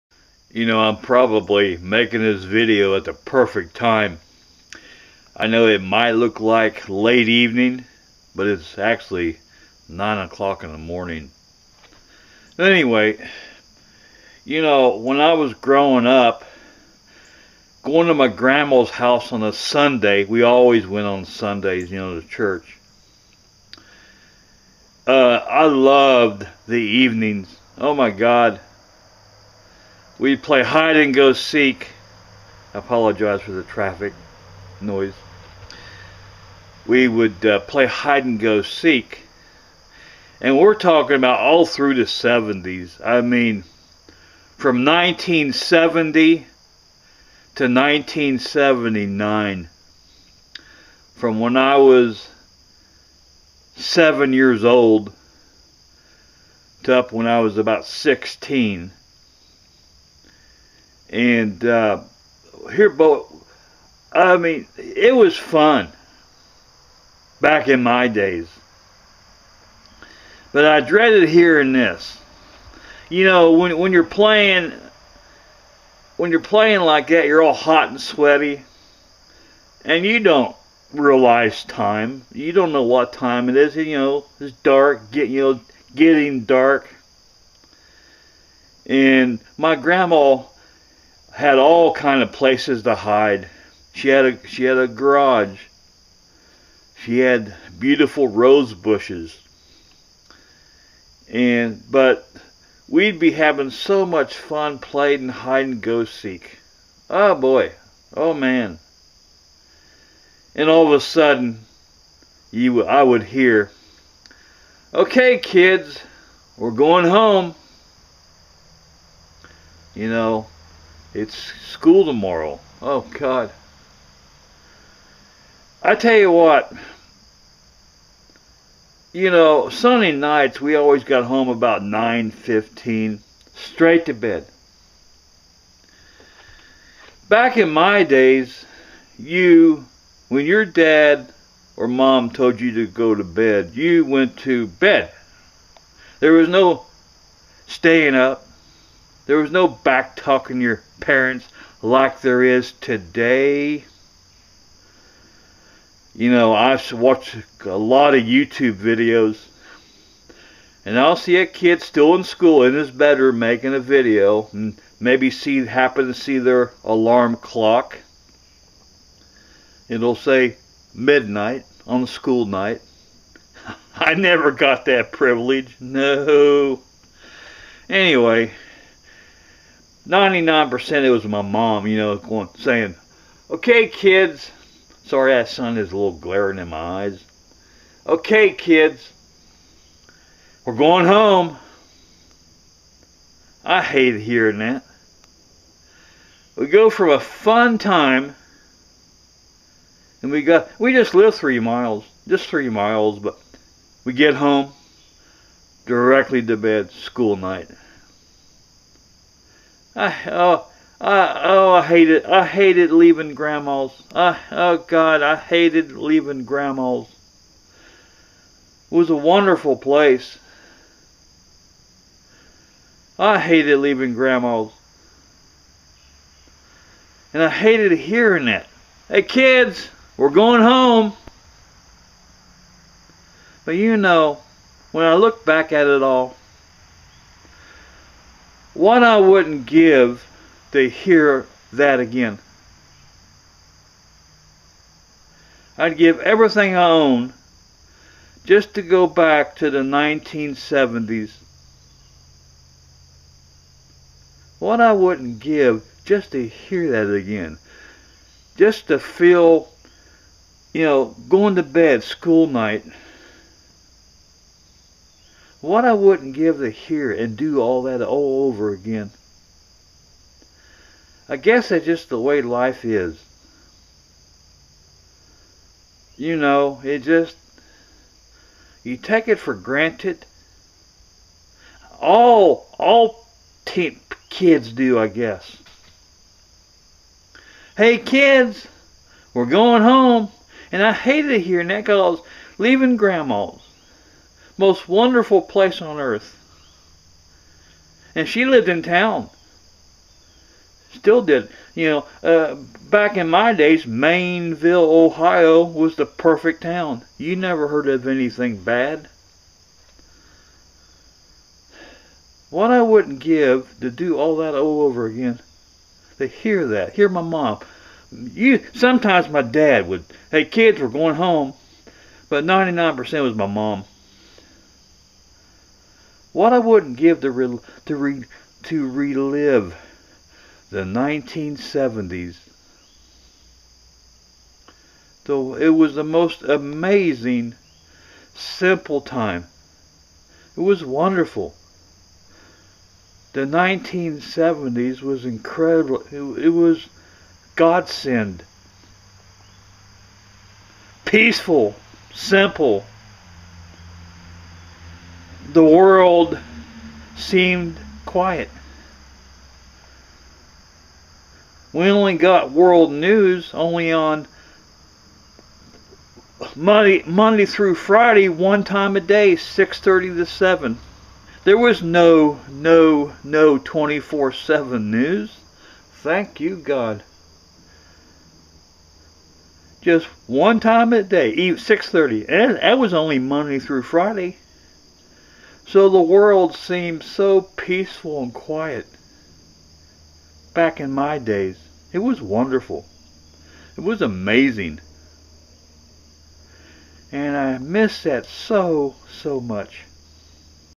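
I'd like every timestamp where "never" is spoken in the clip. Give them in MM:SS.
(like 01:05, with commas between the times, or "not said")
02:54, 05:07.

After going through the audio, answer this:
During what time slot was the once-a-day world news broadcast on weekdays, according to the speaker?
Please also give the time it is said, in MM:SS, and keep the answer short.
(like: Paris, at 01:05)
6:30 to 7, at 06:09.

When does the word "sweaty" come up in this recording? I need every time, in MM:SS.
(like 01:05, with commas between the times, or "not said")
01:17.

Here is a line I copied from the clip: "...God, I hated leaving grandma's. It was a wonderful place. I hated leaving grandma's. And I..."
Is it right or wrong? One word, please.
right.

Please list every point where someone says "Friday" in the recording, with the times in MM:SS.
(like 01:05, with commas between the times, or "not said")
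06:07, 06:23.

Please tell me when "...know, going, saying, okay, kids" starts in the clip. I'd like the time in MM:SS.
03:01.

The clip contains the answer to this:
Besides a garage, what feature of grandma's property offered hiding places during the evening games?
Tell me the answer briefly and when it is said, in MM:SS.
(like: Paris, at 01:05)
rose bushes, at 01:38.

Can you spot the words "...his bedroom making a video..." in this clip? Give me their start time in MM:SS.
02:42.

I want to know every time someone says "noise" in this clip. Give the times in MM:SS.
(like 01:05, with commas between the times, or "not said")
00:34.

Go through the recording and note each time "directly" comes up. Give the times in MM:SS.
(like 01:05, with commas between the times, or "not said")
03:25.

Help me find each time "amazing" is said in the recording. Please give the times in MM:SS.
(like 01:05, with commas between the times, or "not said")
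05:36, 06:34.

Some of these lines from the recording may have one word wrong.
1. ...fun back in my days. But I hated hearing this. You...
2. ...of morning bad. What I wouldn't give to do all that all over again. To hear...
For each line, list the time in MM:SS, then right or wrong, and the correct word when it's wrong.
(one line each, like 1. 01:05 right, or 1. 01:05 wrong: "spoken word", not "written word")
1. 01:05 wrong: "dreaded", not "hated"
2. 05:07 wrong: "anything", not "morning".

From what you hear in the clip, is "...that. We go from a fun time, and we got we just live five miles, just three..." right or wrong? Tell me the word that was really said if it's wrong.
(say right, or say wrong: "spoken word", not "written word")
wrong: "three", not "five".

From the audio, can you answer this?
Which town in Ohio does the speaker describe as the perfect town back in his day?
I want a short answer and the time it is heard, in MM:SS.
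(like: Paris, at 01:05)
Maineville, at 05:03.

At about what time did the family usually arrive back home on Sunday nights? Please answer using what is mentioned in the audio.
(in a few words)
9:15.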